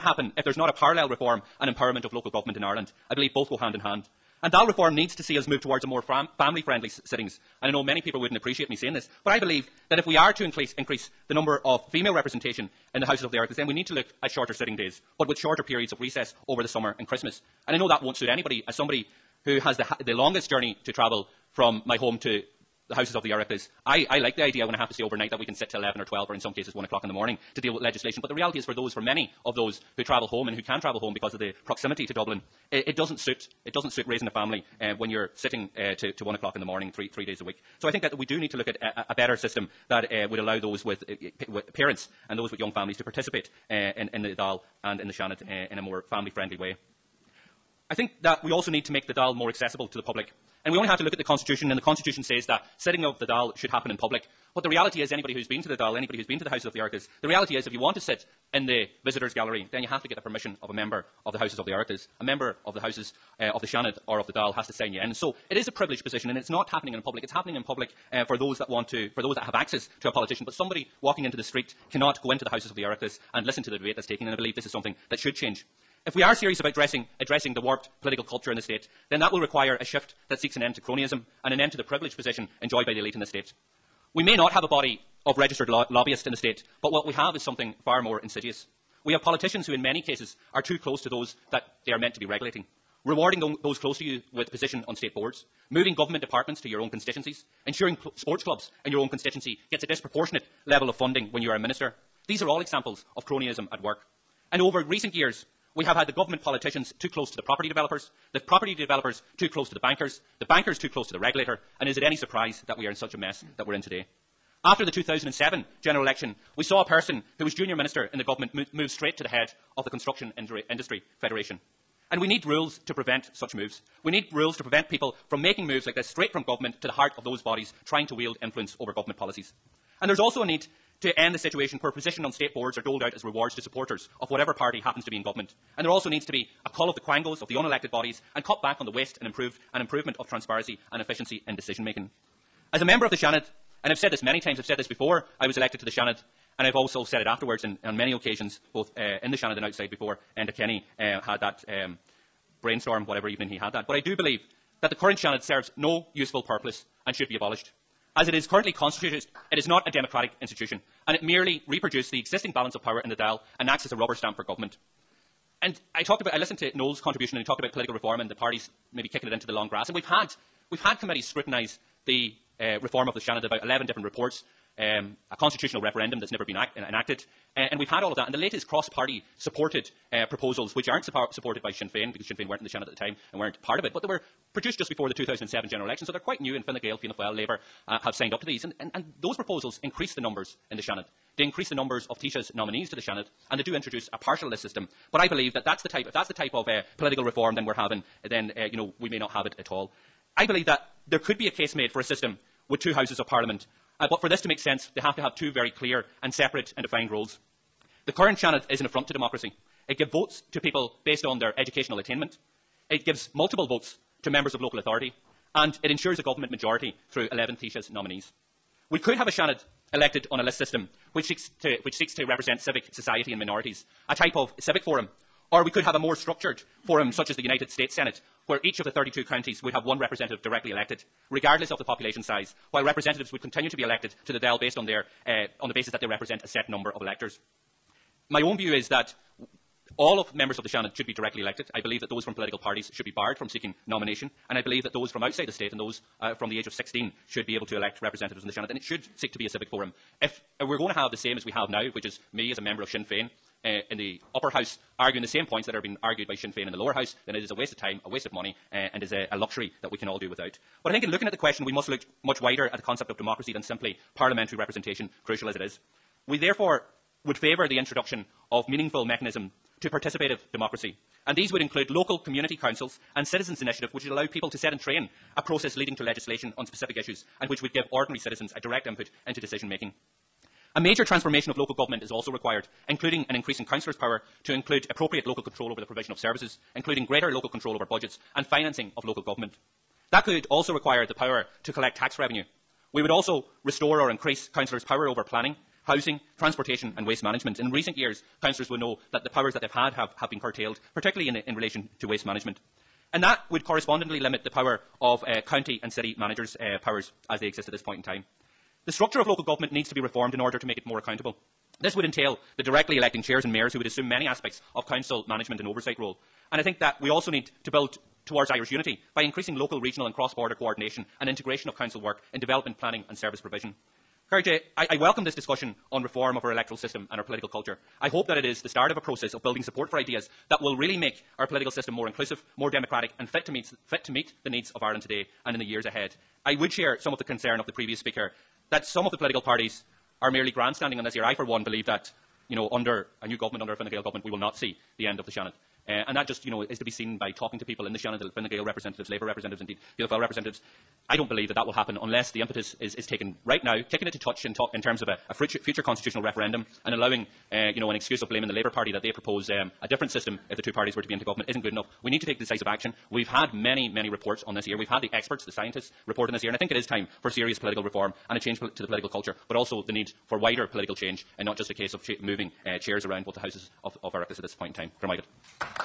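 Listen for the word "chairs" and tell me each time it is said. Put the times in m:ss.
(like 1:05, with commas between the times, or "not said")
5:13, 6:12.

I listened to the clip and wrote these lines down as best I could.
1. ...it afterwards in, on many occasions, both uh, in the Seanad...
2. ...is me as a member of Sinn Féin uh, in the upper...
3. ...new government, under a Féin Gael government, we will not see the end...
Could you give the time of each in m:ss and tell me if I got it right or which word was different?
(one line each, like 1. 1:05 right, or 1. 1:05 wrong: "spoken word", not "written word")
1. 2:27 right
2. 4:12 right
3. 5:43 wrong: "Fine", not "Féin".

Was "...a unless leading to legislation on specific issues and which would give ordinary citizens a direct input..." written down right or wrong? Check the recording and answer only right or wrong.
wrong.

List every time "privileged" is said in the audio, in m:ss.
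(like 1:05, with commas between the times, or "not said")
1:05, 1:21.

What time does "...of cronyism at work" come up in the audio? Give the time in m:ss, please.
1:43.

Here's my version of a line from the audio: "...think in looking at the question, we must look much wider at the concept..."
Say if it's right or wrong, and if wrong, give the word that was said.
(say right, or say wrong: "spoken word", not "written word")
right.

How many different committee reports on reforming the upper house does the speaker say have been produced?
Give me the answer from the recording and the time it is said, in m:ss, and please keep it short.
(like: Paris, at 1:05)
11, at 2:53.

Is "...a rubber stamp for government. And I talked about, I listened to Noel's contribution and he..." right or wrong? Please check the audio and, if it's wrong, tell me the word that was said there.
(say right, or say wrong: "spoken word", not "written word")
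right.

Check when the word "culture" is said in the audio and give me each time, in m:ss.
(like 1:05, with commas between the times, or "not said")
1:18, 5:27, 6:09.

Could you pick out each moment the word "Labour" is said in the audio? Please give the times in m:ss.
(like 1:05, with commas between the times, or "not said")
3:07, 5:49, 5:58.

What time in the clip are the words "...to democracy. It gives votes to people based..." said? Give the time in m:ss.
3:29.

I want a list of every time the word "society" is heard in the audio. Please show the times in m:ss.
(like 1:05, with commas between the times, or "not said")
3:42.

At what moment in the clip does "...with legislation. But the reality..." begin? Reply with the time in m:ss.
0:27.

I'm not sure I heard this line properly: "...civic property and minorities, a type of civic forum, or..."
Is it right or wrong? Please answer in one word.
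wrong.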